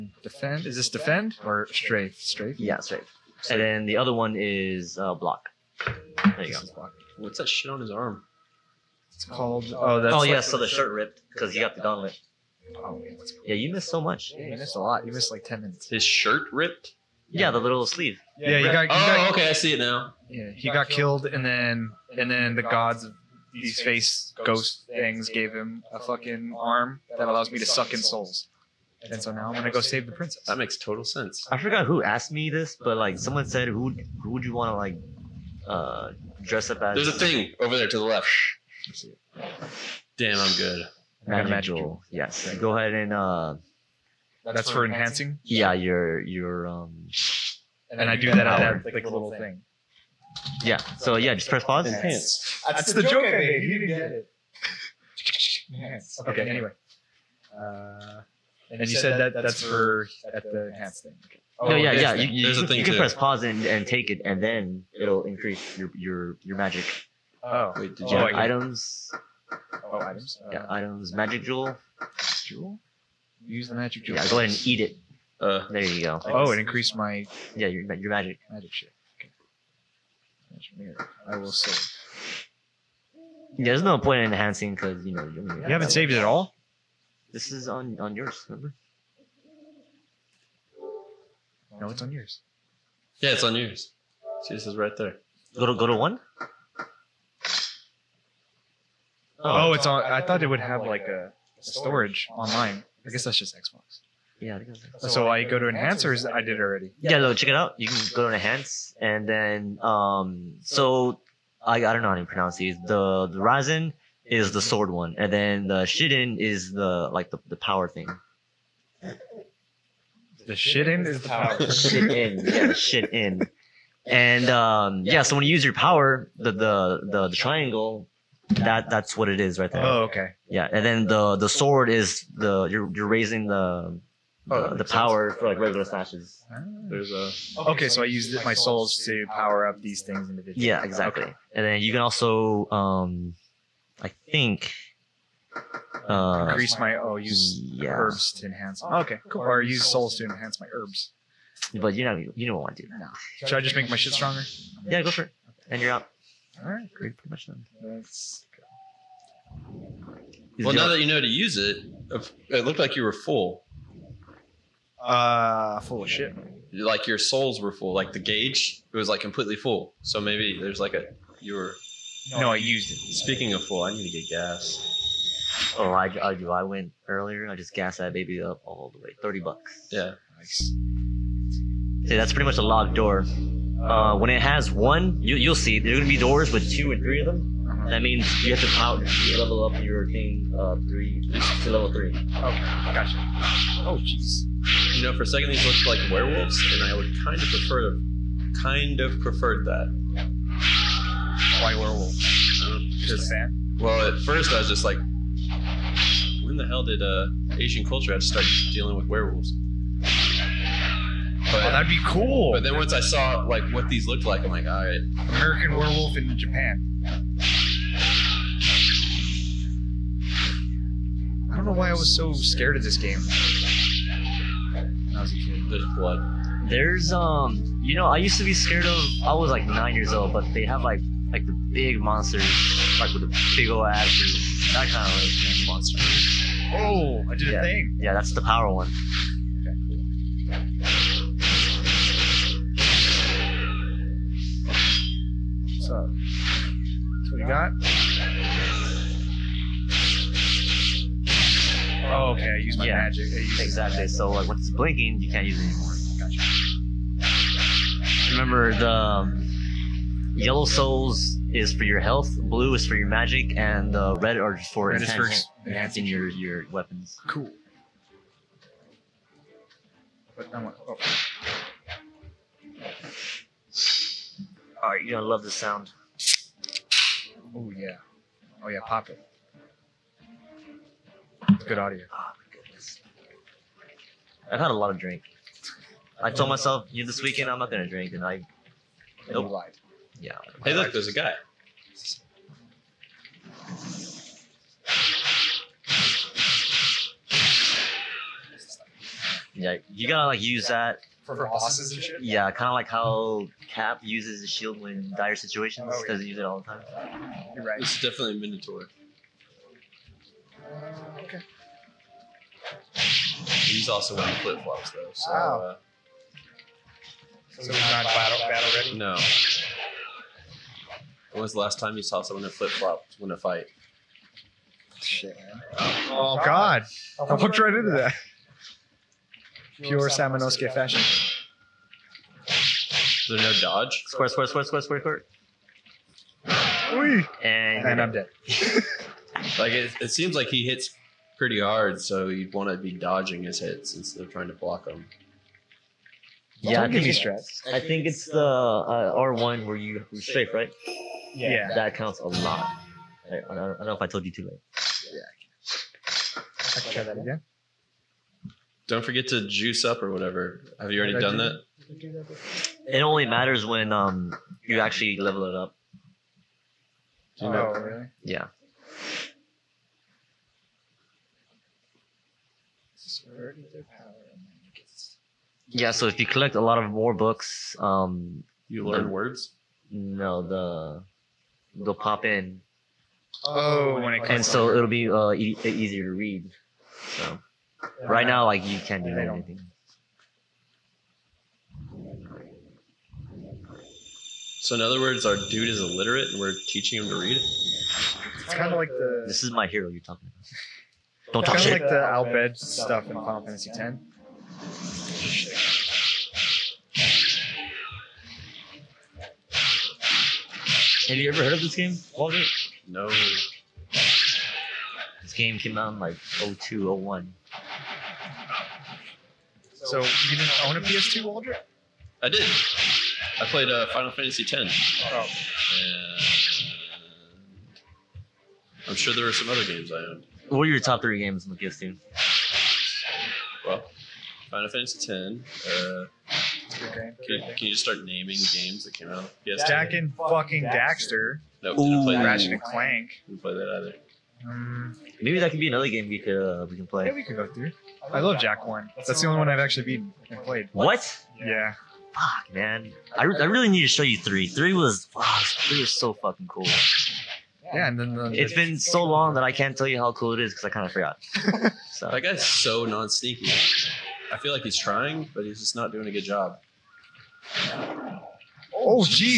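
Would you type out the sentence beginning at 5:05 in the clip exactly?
Oh, Doesn't use it all the time.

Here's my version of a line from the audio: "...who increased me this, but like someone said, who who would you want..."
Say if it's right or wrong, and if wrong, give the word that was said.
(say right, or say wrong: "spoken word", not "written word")
wrong: "asked", not "increased".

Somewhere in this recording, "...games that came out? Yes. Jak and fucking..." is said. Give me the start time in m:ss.
7:18.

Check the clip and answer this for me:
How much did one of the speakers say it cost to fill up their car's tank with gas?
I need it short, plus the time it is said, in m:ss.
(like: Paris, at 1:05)
$30, at 2:59.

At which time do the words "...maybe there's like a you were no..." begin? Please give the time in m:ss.
2:50.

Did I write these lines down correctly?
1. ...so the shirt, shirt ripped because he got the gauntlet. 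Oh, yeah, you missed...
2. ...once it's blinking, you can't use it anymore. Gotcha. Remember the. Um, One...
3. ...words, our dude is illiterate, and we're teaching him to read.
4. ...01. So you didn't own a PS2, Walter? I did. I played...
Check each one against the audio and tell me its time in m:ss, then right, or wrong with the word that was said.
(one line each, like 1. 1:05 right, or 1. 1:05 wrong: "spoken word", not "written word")
1. 0:10 right
2. 4:14 wrong: "Yellow", not "One"
3. 6:34 right
4. 6:56 right.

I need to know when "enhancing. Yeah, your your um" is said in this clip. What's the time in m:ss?
0:45.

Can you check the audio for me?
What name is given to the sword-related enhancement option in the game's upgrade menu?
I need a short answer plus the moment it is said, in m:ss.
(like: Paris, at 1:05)
Raizan, at 1:53.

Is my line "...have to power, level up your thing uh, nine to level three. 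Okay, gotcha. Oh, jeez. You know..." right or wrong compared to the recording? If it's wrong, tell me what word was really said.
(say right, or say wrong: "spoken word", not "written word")
wrong: "three", not "nine".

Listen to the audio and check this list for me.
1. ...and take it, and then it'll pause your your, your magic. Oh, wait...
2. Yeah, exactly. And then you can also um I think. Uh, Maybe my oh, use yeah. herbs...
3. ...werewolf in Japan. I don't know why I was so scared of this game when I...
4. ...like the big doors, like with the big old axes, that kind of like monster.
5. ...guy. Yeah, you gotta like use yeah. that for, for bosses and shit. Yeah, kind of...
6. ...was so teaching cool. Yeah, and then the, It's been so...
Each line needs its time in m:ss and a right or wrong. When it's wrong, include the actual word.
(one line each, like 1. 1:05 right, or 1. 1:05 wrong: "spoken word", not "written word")
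1. 1:03 wrong: "increase", not "pause"
2. 2:20 wrong: "Increase", not "Maybe"
3. 3:35 right
4. 3:51 wrong: "monsters", not "doors"
5. 4:51 right
6. 7:35 wrong: "fucking", not "teaching".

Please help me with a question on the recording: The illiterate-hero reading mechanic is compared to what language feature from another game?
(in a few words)
Al Bhed.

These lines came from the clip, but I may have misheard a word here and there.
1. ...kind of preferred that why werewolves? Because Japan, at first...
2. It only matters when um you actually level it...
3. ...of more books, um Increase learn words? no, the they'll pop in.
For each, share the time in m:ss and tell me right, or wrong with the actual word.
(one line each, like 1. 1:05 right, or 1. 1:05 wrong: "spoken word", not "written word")
1. 3:18 wrong: "Well", not "Japan"
2. 6:02 right
3. 6:16 wrong: "You", not "Increase".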